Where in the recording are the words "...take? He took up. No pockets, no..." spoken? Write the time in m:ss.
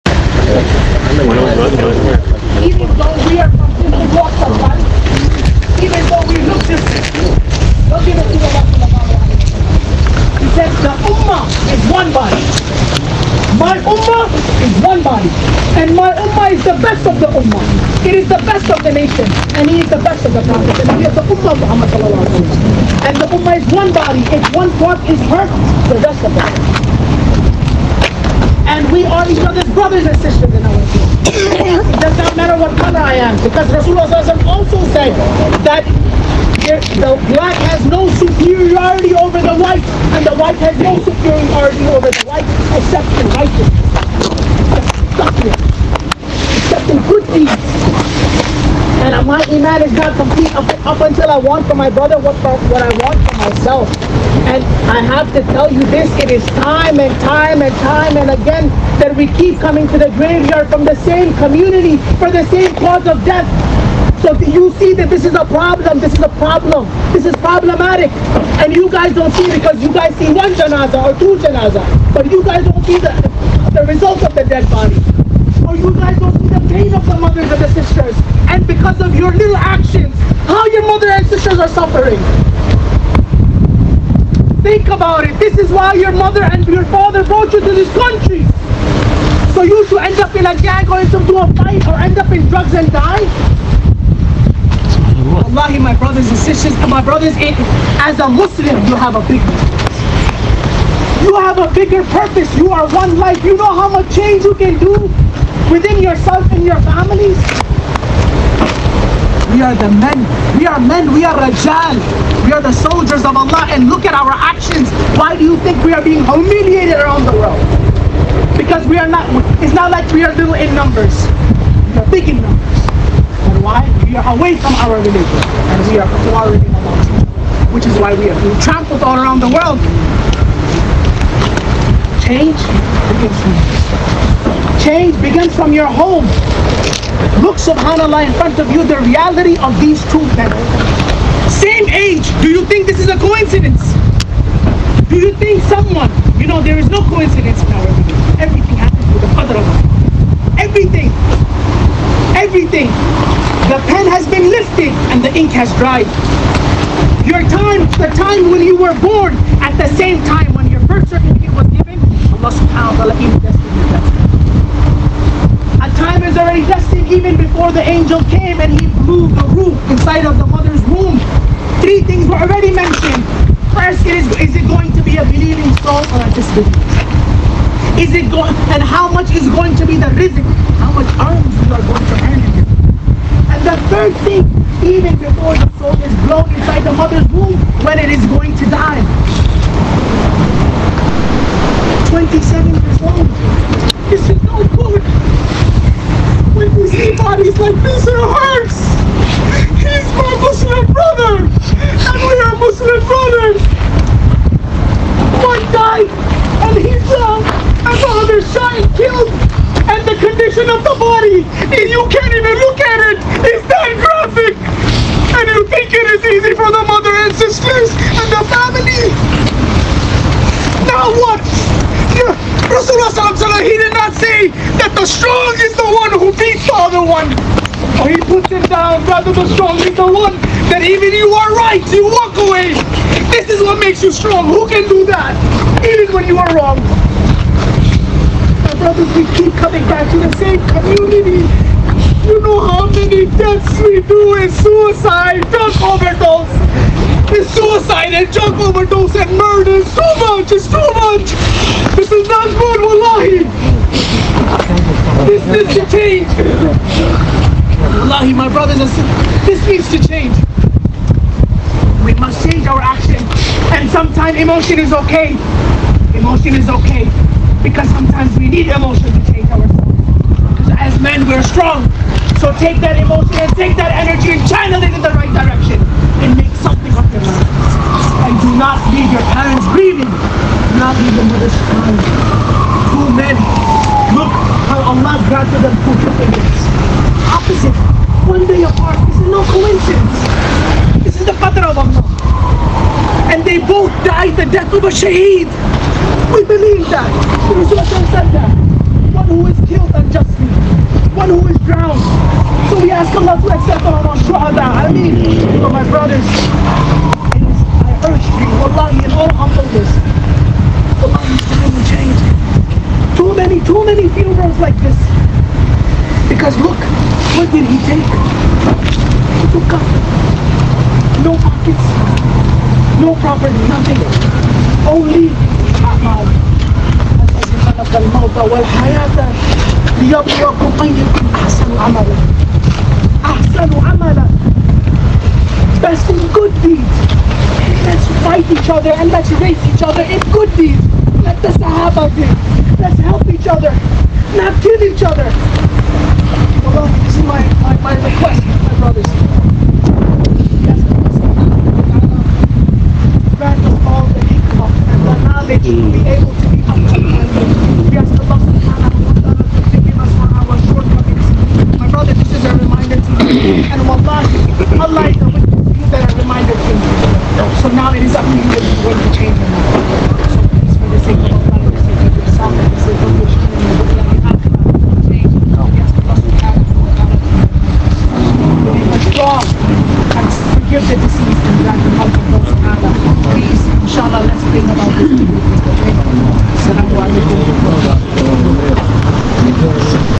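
5:17.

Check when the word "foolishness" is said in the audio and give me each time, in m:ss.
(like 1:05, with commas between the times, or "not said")
not said.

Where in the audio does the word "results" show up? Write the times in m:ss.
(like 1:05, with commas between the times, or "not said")
1:13.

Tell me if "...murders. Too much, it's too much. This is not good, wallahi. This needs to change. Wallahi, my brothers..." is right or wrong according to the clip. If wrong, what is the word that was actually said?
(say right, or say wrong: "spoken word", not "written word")
right.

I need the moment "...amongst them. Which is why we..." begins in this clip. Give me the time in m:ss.
2:06.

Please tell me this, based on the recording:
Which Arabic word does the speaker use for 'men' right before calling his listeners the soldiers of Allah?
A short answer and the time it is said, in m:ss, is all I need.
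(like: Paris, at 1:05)
Rajal, at 1:51.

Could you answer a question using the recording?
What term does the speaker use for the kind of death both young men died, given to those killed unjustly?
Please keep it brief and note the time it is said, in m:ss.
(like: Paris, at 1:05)
shaheed, at 4:54.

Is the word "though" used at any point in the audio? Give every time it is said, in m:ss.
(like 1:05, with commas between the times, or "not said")
0:01, 0:06.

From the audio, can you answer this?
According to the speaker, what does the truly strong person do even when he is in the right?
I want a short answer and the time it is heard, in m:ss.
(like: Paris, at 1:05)
walk away, at 3:51.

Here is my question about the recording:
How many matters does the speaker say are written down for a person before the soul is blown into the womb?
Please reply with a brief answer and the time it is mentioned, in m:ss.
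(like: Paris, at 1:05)
3, at 2:51.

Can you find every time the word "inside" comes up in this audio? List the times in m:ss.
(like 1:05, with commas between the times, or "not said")
2:49, 3:06.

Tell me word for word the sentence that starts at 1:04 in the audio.
So you see that this is a problem, this is a problem, this is problematic.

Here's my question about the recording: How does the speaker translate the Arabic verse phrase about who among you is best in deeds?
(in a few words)
Best in good deeds.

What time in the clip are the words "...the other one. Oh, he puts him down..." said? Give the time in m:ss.
3:46.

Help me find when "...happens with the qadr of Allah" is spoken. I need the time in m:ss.
2:28.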